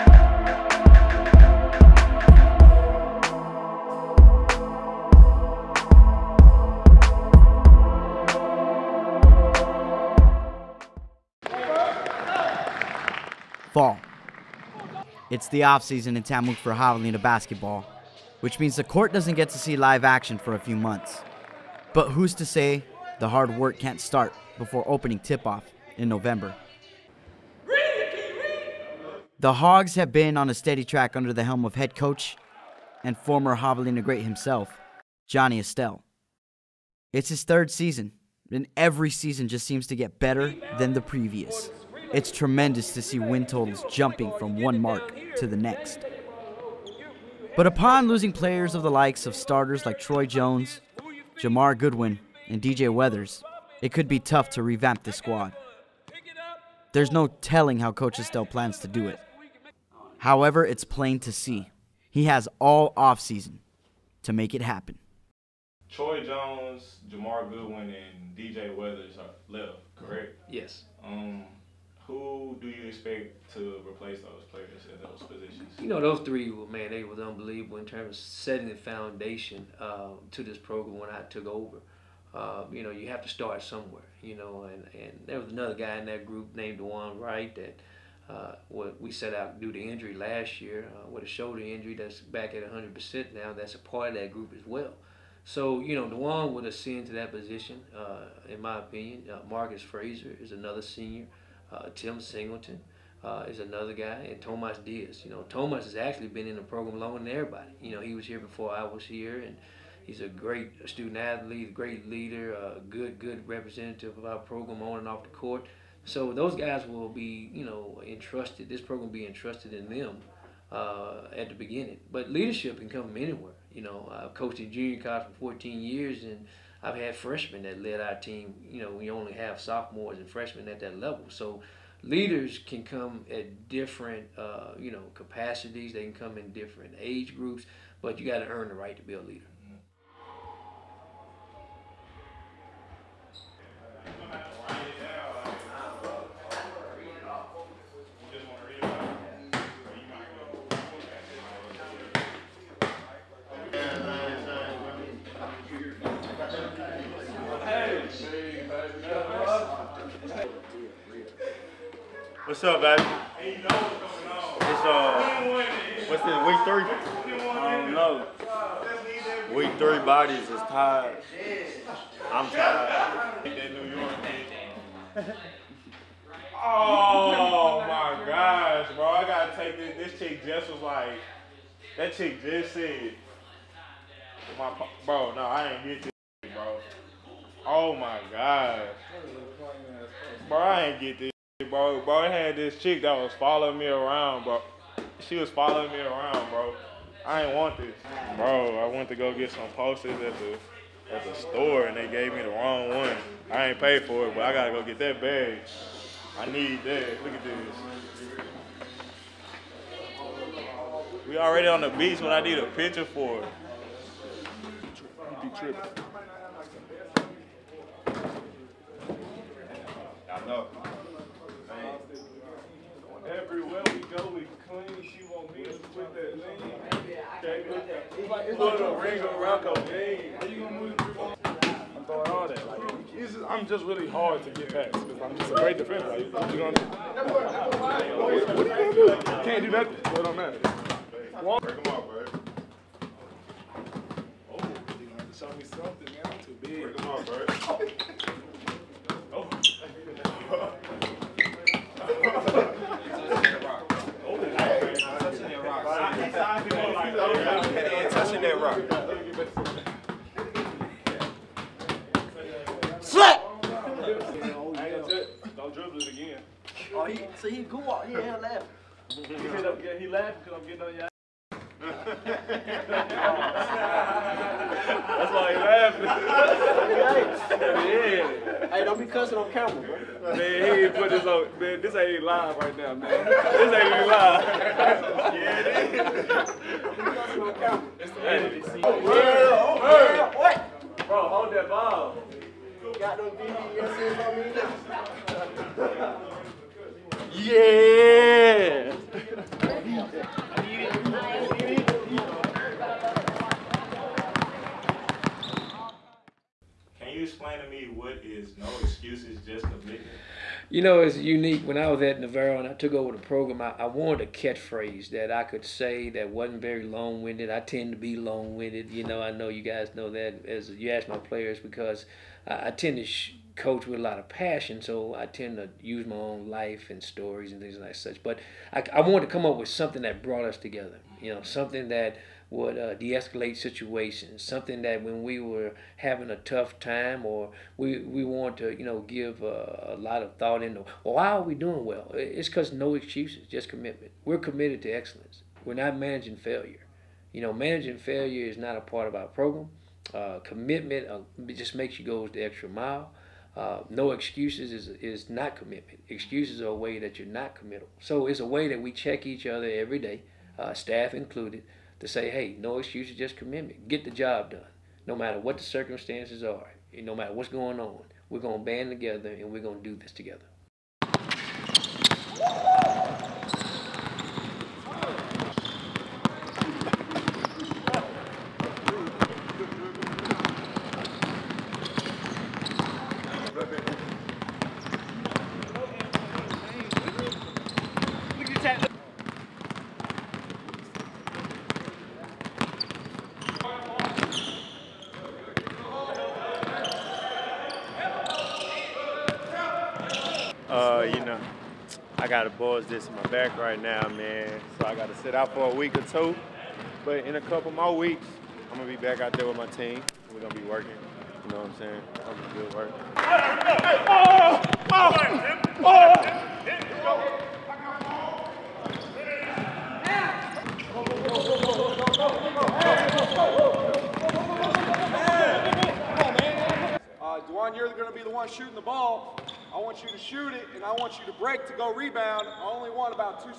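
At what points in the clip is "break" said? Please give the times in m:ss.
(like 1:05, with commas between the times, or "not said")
4:00, 4:06, 7:11.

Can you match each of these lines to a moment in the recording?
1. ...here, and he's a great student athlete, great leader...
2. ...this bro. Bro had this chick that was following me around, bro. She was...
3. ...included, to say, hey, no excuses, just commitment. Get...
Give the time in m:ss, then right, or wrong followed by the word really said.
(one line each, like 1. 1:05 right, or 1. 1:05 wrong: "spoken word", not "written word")
1. 1:49 right
2. 3:11 right
3. 6:01 right.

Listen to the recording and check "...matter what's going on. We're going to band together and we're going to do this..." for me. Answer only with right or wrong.
right.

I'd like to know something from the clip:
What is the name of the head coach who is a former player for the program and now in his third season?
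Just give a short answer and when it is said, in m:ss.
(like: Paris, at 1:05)
Johnny Estelle, at 0:35.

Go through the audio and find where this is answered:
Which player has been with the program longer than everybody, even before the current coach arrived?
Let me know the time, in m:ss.
1:44.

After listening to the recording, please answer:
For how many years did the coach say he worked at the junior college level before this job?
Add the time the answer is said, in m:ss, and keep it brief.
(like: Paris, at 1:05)
14, at 2:05.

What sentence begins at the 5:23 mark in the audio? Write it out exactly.
Sh- coach with a lot of passion, so I tend to use my own life and stories and things like such.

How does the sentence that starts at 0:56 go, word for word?
There's no telling how Coach Estelle plans to do it.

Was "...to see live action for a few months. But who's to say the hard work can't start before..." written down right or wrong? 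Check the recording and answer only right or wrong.
right.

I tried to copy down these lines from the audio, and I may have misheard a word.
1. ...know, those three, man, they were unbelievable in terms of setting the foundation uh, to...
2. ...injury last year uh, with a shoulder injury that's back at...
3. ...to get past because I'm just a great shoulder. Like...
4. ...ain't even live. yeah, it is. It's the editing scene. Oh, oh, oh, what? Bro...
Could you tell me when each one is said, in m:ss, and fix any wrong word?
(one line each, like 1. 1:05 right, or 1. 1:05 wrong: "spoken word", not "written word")
1. 1:15 right
2. 1:29 right
3. 3:54 wrong: "defender", not "shoulder"
4. 4:43 right.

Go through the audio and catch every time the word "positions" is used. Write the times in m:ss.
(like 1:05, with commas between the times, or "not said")
1:15, 1:37.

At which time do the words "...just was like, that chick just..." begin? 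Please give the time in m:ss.
3:00.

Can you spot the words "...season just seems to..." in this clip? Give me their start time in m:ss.
0:39.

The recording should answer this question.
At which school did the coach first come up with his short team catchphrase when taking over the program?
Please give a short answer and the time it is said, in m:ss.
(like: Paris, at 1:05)
Navarro, at 5:12.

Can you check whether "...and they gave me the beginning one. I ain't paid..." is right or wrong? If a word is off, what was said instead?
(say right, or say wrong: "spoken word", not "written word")
wrong: "wrong", not "beginning".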